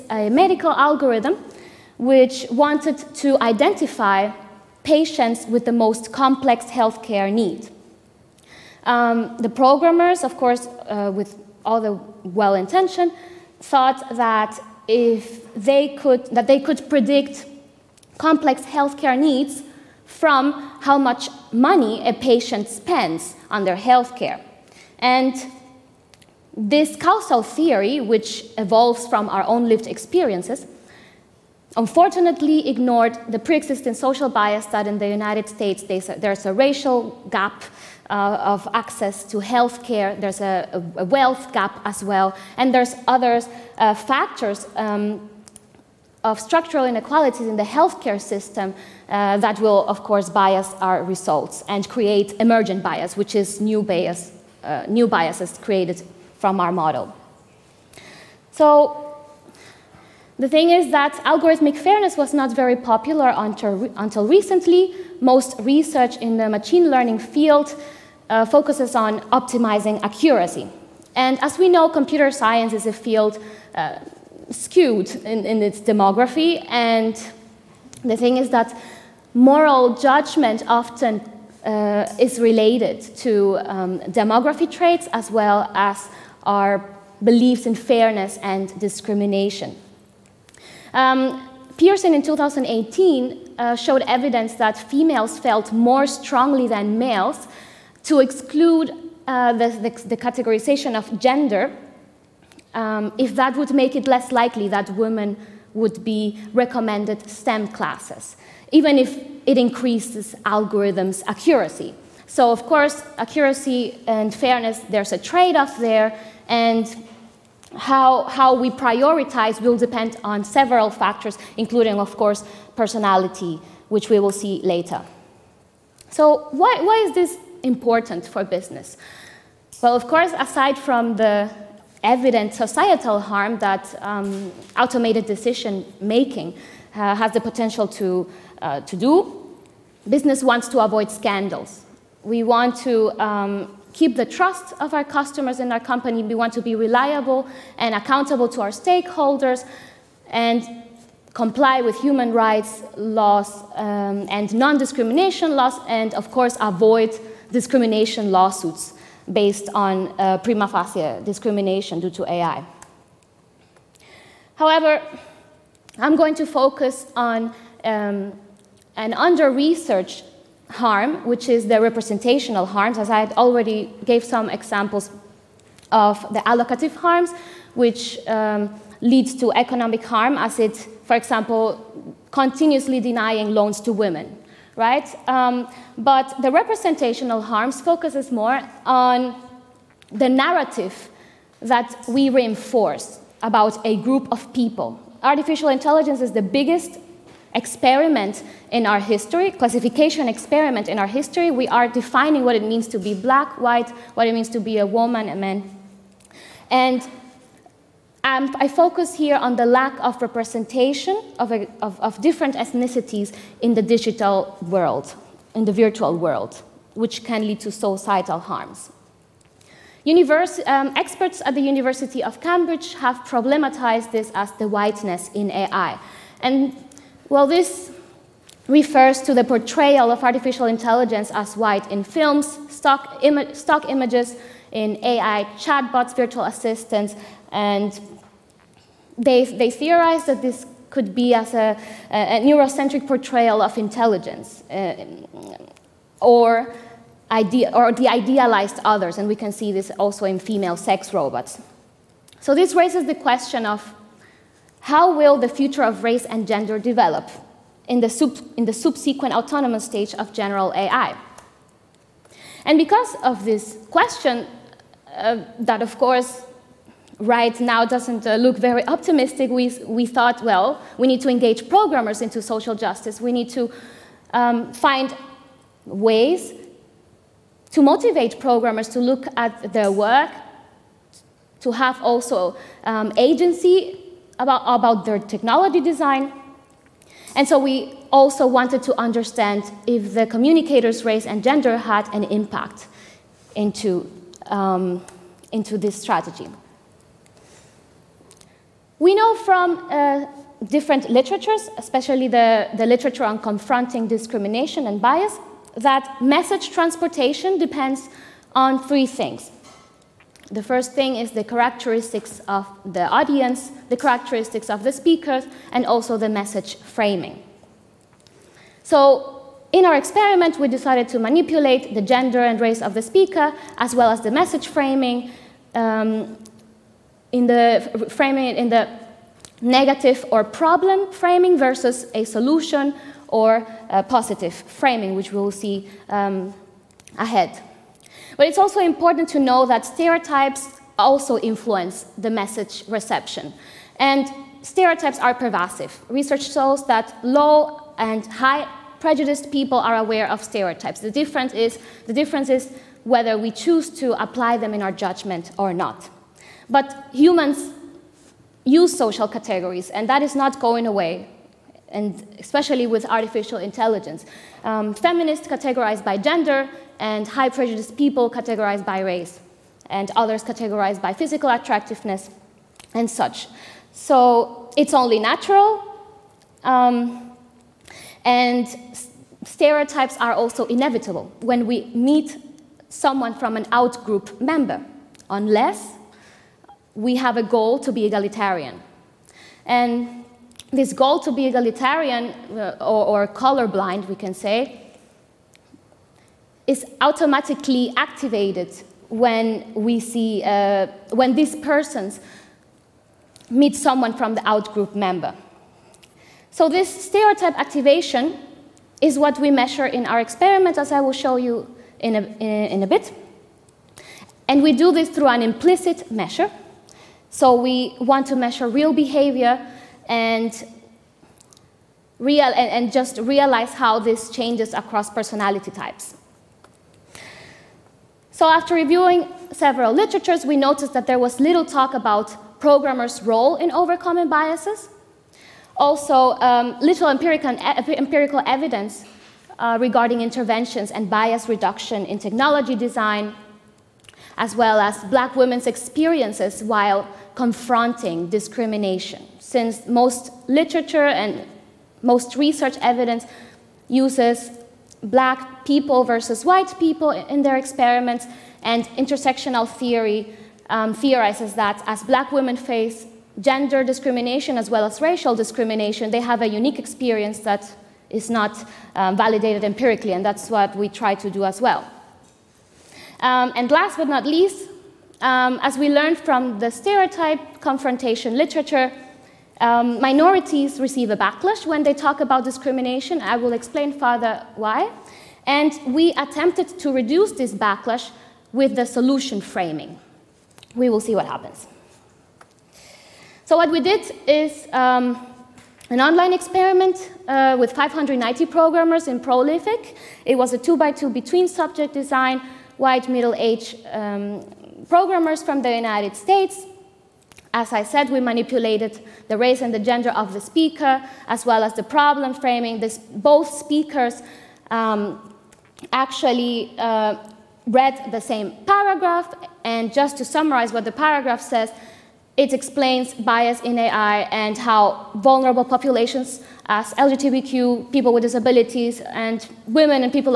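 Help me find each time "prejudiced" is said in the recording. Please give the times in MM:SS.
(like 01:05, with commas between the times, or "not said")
05:48, 06:07.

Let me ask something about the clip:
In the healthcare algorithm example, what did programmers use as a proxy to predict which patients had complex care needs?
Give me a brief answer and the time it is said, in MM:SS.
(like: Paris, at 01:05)
How much money a patient spends, at 00:20.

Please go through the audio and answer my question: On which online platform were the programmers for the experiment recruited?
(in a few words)
Prolific.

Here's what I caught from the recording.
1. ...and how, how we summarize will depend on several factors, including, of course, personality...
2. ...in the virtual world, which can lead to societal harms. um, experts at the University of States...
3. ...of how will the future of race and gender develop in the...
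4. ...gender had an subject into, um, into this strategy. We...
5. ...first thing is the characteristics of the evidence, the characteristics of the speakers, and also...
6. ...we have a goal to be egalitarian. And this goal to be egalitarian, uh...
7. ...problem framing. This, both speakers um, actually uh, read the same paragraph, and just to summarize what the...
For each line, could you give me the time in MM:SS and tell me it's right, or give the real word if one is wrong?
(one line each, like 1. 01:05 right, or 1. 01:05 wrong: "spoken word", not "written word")
1. 01:56 wrong: "prioritize", not "summarize"
2. 03:35 wrong: "Cambridge", not "States"
3. 04:13 right
4. 04:51 wrong: "impact", not "subject"
5. 05:10 wrong: "audience", not "evidence"
6. 06:26 right
7. 08:31 right.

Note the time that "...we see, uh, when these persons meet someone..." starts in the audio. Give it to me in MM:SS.
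06:39.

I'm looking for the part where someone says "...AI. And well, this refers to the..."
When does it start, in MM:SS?
03:45.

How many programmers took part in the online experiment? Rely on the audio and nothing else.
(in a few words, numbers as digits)
590.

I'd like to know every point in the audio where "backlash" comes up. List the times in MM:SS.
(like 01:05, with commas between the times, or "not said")
08:01, 08:07.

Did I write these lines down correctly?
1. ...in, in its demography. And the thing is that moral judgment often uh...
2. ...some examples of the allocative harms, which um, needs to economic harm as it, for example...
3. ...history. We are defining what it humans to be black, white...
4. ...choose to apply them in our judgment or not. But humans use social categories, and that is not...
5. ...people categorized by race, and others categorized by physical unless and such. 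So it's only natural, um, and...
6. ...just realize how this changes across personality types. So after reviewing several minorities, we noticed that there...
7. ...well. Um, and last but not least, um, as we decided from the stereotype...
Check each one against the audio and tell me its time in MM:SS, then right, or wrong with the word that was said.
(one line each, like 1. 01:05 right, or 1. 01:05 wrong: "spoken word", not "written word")
1. 01:15 right
2. 02:54 wrong: "leads", not "needs"
3. 03:21 wrong: "means", not "humans"
4. 05:53 right
5. 06:07 wrong: "attractiveness", not "unless"
6. 07:02 wrong: "literatures", not "minorities"
7. 07:51 wrong: "learned", not "decided".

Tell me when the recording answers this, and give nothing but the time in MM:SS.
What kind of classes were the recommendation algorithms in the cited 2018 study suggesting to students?
01:47.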